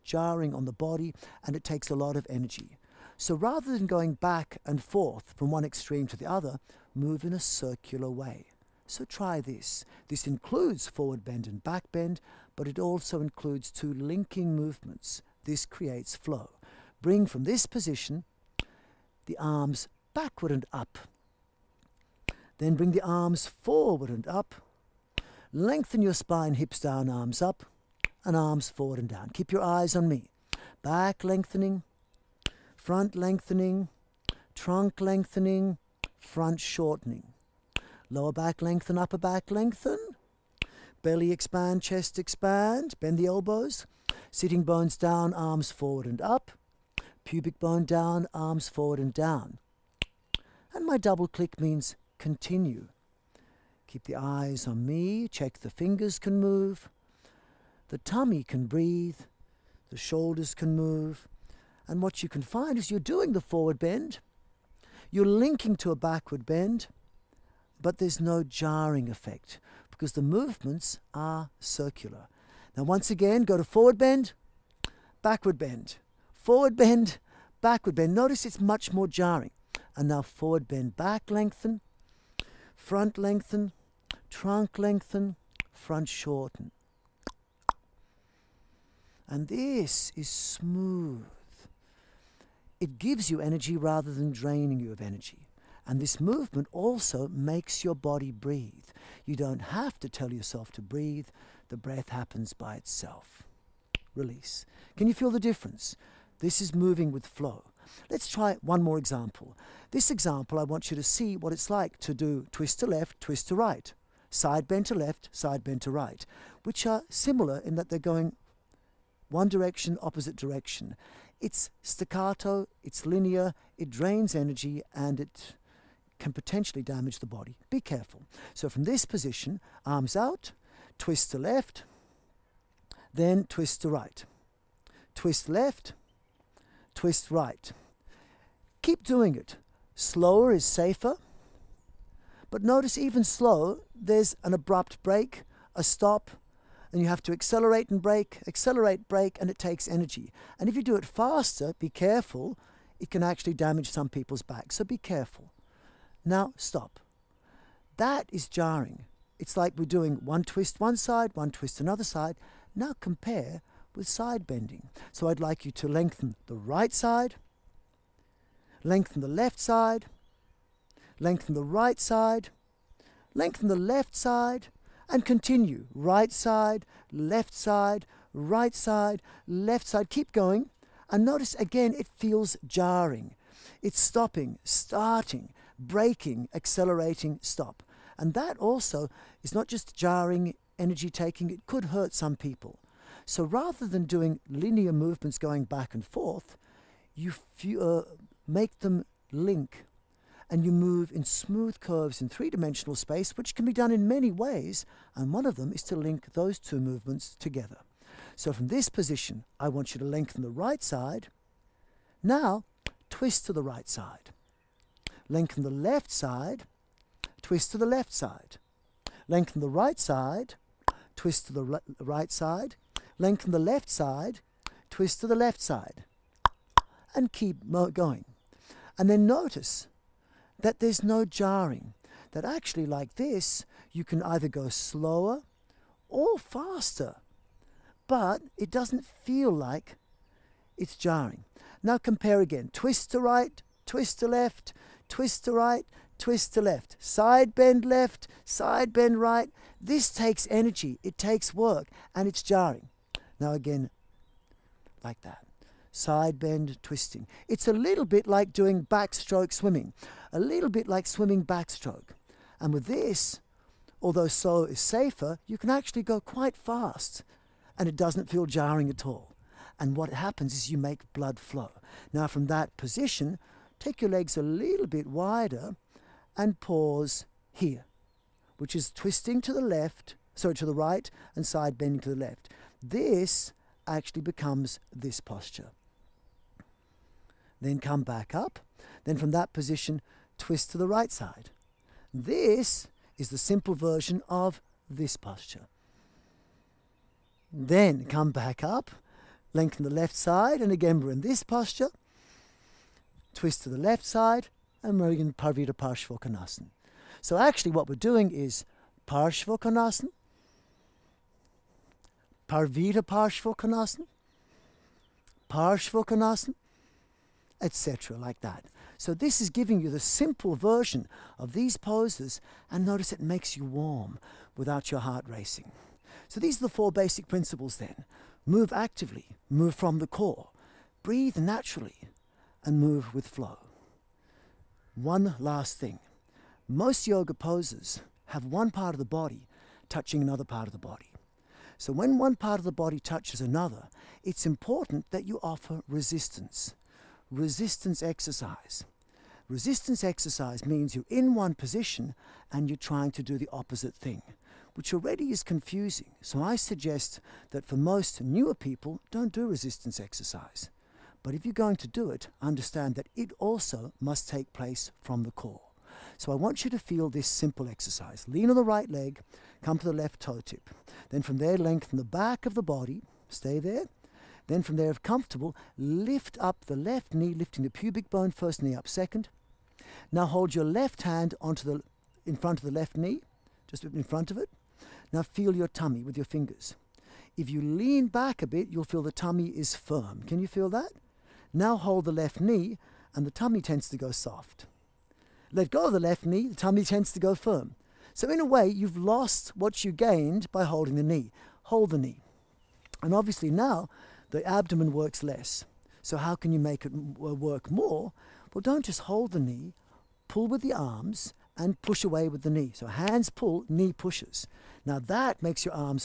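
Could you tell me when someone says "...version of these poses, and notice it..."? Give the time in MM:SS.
05:20.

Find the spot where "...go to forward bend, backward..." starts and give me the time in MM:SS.
01:13.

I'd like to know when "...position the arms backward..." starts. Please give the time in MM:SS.
00:17.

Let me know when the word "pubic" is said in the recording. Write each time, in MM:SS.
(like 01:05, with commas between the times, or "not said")
00:47, 06:17.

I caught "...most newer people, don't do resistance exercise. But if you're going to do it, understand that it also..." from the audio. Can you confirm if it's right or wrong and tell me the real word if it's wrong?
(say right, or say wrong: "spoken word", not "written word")
right.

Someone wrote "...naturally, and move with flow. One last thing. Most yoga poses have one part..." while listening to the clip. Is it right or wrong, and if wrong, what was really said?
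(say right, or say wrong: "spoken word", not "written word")
right.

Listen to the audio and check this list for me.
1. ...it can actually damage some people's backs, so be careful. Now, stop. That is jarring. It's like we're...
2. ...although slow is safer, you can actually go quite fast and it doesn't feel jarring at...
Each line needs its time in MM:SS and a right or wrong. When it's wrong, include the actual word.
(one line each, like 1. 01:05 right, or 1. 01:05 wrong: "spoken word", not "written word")
1. 02:32 right
2. 04:24 right.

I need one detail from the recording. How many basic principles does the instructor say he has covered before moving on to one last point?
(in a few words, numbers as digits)
4.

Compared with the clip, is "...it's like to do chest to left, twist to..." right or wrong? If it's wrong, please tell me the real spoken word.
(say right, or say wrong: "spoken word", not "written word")
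wrong: "twist", not "chest".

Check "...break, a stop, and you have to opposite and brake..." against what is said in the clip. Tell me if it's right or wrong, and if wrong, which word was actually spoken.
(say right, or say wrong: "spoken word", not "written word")
wrong: "accelerate", not "opposite".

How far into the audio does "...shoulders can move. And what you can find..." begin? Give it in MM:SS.
00:59.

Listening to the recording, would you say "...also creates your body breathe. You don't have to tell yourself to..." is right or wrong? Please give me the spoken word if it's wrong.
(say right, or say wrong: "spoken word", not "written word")
wrong: "makes", not "creates".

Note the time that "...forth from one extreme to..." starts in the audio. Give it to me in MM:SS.
00:04.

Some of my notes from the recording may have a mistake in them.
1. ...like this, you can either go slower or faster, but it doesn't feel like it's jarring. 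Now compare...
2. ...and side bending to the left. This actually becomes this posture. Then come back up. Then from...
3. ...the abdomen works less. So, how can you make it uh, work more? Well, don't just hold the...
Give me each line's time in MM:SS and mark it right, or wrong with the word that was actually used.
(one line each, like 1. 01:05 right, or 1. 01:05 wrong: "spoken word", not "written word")
1. 03:52 right
2. 04:41 right
3. 06:44 right.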